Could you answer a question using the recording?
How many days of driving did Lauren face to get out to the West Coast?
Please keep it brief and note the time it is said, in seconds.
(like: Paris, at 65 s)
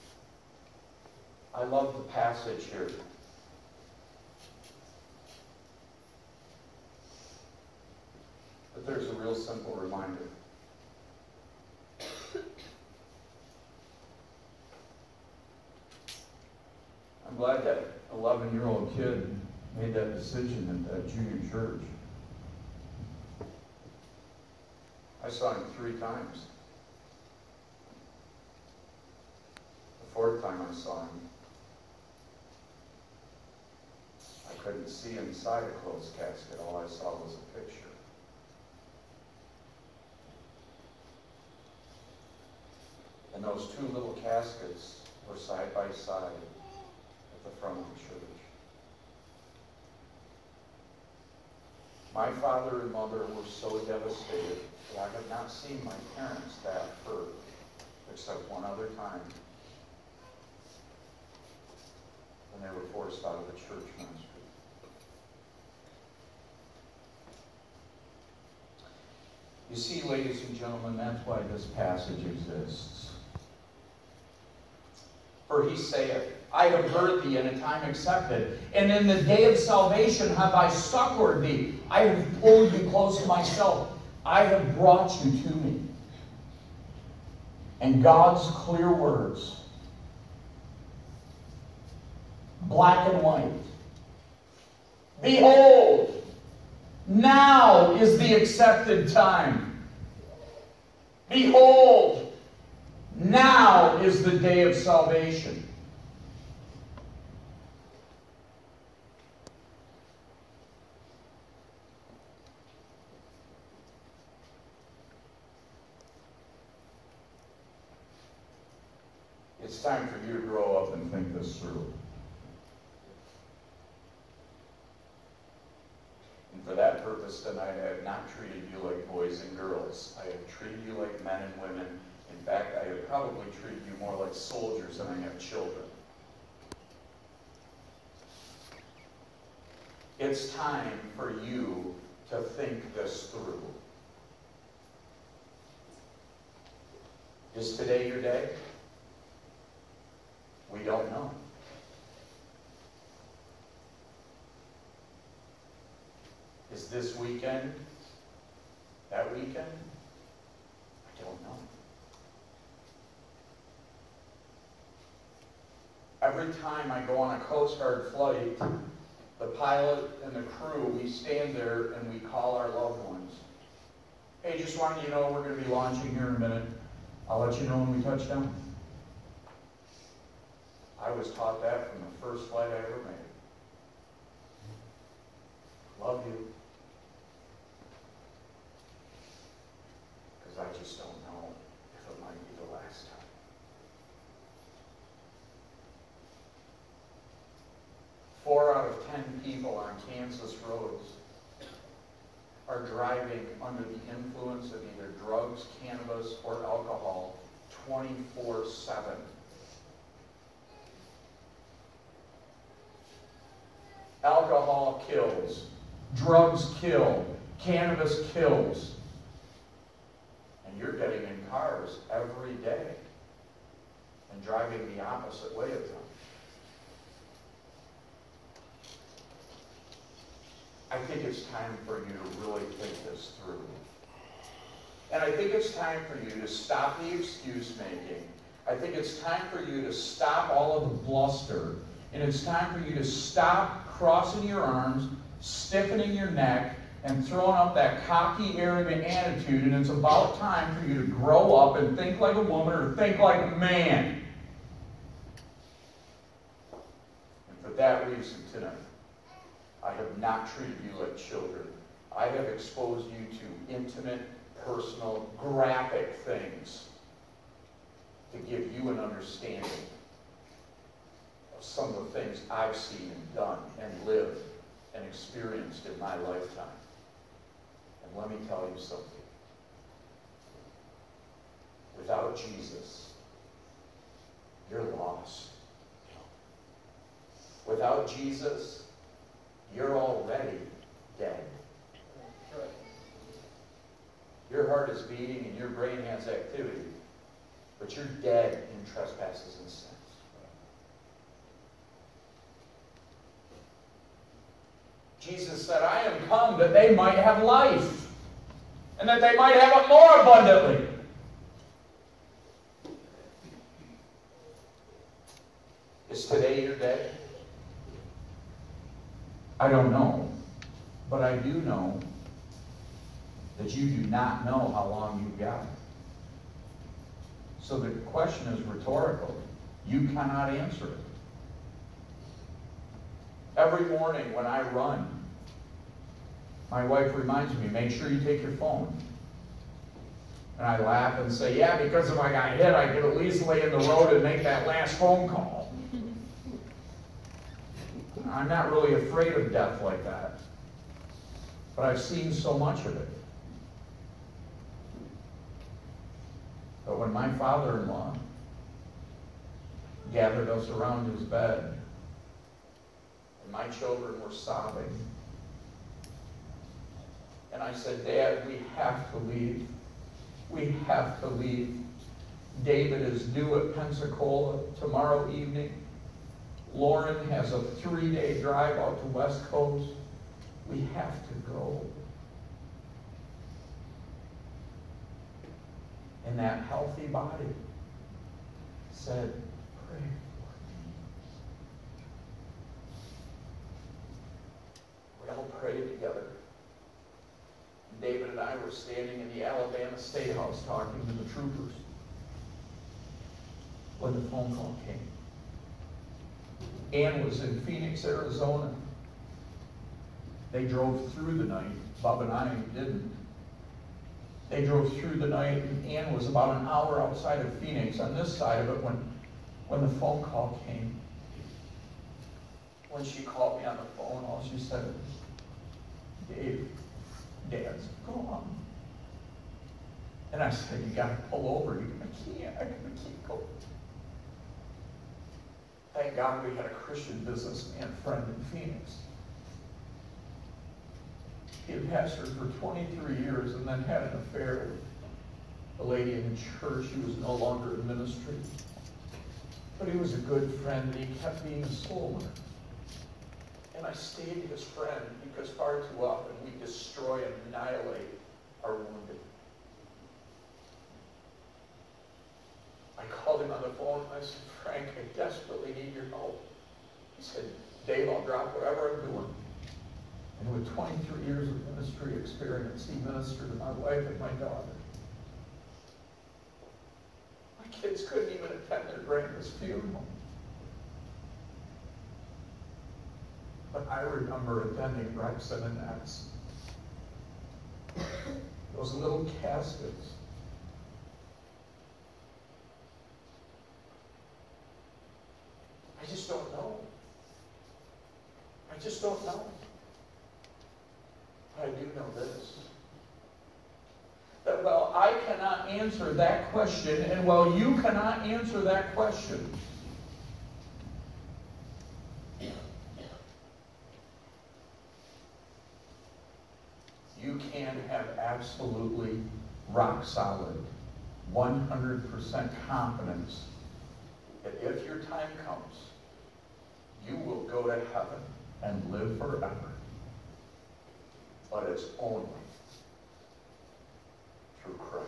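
3, at 377 s.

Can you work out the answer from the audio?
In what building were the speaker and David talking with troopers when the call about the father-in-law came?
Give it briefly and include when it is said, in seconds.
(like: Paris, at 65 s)
Alabama State House, at 399 s.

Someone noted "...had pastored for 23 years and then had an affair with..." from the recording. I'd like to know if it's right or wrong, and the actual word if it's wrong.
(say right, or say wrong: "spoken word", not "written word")
right.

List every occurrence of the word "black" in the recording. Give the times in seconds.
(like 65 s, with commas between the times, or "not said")
92 s.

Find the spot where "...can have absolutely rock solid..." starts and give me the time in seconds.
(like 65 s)
517 s.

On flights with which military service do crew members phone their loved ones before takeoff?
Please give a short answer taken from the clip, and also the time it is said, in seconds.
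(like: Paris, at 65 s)
Coast Guard, at 167 s.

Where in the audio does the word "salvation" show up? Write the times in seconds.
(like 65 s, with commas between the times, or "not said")
79 s, 104 s.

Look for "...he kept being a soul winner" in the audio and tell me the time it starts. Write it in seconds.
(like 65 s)
451 s.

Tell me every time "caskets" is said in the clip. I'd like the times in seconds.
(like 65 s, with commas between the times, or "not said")
36 s, 44 s, 489 s.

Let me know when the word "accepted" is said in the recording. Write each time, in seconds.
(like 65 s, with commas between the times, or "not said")
77 s, 98 s.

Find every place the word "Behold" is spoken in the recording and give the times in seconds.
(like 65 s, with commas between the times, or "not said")
95 s, 101 s.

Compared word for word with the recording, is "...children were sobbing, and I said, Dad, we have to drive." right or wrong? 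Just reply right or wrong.
wrong.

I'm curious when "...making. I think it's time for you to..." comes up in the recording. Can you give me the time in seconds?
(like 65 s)
237 s.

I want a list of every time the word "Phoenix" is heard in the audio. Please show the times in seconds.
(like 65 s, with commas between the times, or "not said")
407 s, 417 s, 438 s.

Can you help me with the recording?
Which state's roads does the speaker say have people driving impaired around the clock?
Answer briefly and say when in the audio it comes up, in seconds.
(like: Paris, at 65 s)
Kansas, at 200 s.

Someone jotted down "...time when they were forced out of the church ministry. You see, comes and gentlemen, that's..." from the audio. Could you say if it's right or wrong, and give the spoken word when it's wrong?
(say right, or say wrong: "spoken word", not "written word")
wrong: "ladies", not "comes".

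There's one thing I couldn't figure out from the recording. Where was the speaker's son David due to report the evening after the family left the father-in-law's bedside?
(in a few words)
Pensacola.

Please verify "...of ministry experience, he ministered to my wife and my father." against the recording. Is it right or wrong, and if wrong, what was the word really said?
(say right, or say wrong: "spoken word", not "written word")
wrong: "daughter", not "father".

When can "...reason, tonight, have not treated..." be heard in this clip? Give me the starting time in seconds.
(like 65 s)
258 s.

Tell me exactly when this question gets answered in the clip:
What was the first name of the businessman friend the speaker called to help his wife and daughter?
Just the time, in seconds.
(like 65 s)
464 s.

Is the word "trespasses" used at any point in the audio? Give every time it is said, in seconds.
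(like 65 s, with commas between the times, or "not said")
298 s.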